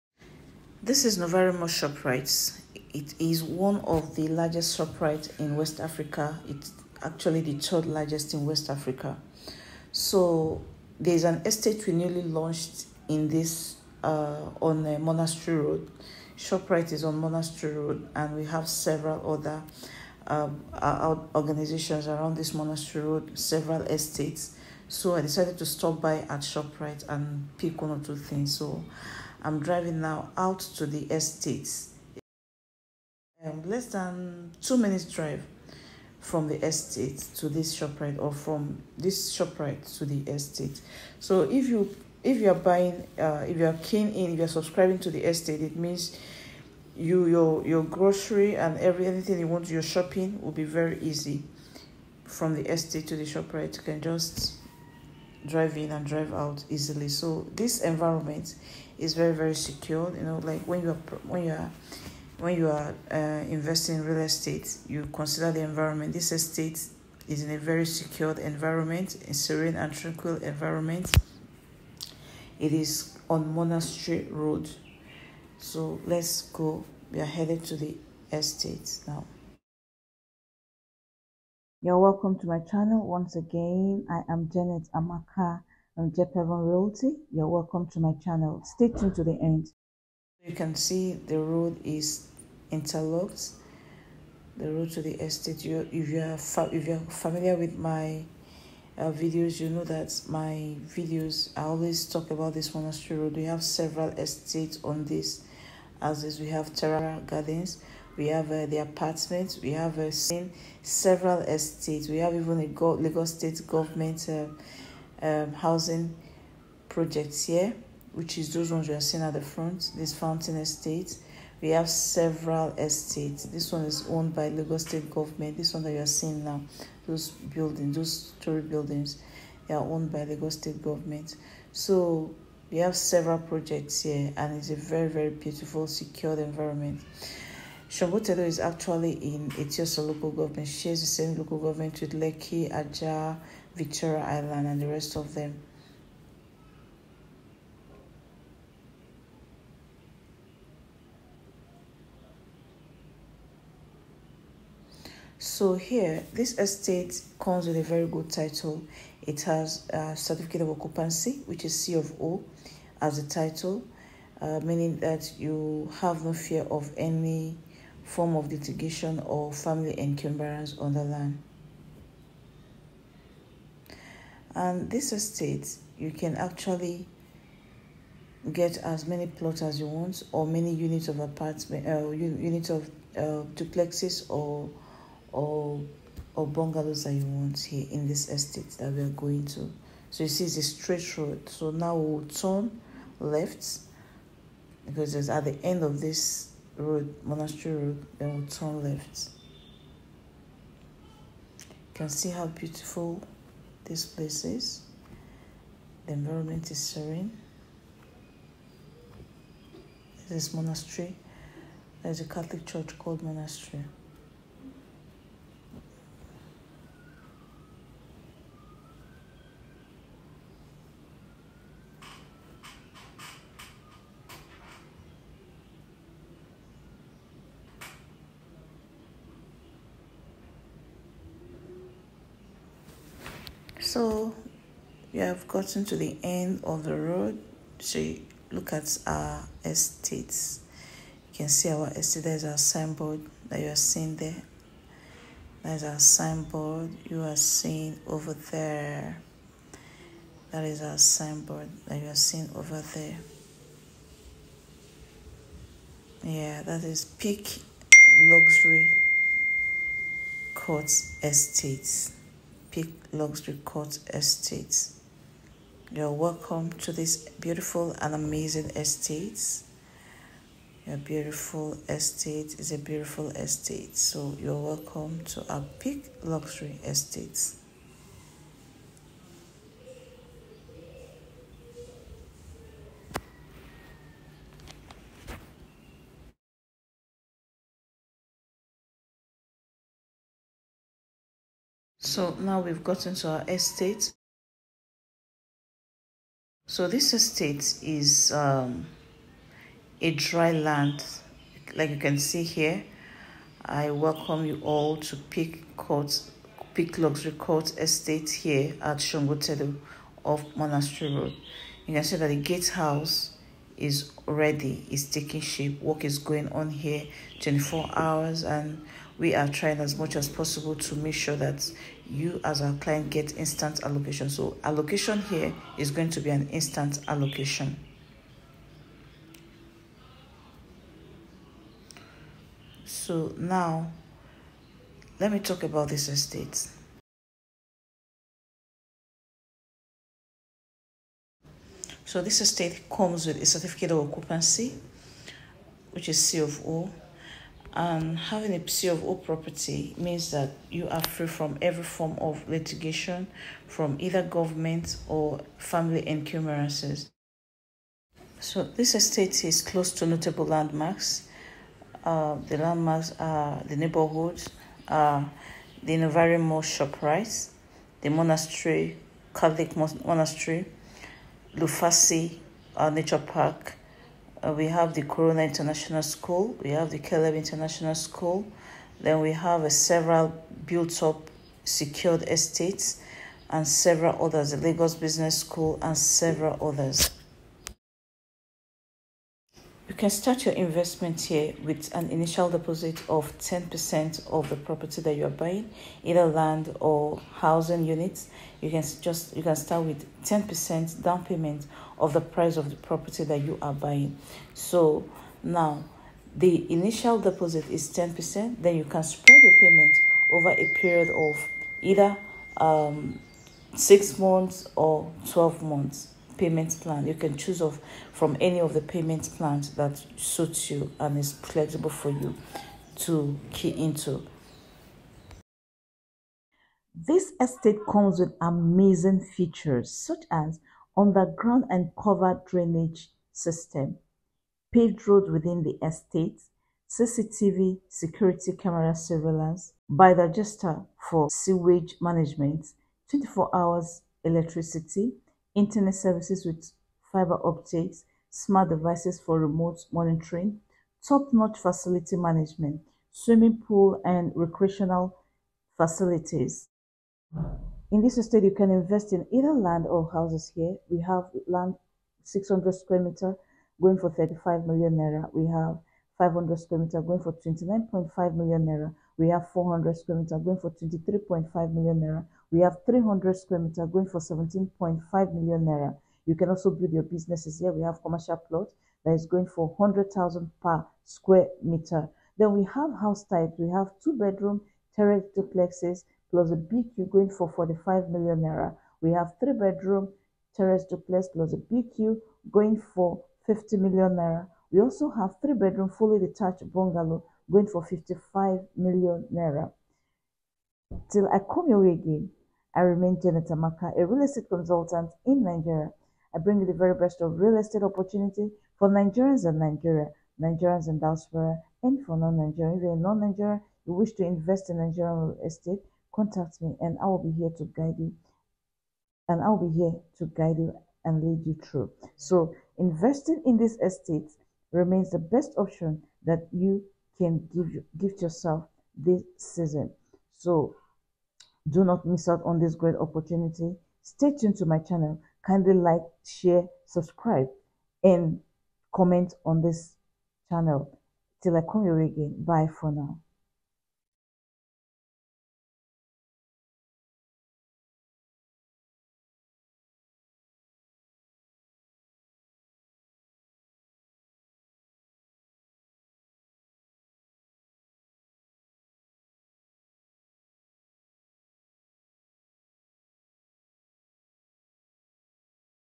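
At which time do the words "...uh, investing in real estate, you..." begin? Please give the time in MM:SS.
01:03.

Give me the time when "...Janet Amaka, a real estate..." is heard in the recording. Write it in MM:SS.
08:23.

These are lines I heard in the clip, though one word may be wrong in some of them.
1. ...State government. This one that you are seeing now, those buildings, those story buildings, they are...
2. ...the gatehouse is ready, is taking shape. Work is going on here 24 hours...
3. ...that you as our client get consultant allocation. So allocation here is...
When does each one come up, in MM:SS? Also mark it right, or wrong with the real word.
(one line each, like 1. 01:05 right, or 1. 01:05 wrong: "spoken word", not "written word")
1. 02:04 right
2. 05:12 right
3. 05:21 wrong: "instant", not "consultant".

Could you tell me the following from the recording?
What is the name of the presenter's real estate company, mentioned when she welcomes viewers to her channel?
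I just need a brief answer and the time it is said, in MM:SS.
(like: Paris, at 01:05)
Jep Haven Realty, at 01:26.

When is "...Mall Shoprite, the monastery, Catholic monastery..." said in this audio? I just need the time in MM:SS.
06:06.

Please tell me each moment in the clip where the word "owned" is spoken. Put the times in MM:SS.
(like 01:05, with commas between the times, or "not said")
02:04, 02:09.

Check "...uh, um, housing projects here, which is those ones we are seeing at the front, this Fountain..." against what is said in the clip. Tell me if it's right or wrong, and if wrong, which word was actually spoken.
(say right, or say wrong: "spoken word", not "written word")
right.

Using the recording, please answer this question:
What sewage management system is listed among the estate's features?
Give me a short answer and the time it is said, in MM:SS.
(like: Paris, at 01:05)
Bio-digester, at 07:19.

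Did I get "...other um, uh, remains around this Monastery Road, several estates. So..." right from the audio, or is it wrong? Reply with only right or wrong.
wrong.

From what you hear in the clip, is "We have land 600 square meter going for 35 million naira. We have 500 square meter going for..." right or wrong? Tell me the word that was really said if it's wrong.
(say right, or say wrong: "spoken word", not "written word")
right.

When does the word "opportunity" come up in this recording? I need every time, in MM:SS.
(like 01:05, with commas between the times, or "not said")
08:27, 08:52.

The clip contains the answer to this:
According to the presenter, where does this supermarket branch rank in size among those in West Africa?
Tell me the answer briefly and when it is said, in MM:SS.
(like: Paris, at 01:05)
Third largest, at 00:07.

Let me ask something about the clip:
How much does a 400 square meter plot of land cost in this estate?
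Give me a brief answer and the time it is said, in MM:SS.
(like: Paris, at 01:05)
23.5 million naira, at 07:50.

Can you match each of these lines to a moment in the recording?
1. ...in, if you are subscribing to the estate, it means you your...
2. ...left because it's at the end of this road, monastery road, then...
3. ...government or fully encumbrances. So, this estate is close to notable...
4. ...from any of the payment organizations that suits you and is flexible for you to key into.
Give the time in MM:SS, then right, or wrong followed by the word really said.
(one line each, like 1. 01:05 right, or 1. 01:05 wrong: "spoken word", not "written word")
1. 00:44 right
2. 03:13 right
3. 05:54 wrong: "family", not "fully"
4. 06:58 wrong: "plans", not "organizations".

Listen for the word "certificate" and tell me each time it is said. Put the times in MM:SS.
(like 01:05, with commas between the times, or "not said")
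02:40, 05:43.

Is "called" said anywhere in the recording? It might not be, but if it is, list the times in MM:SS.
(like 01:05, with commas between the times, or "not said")
03:32.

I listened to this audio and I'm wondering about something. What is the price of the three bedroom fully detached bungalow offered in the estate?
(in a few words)
55 million naira.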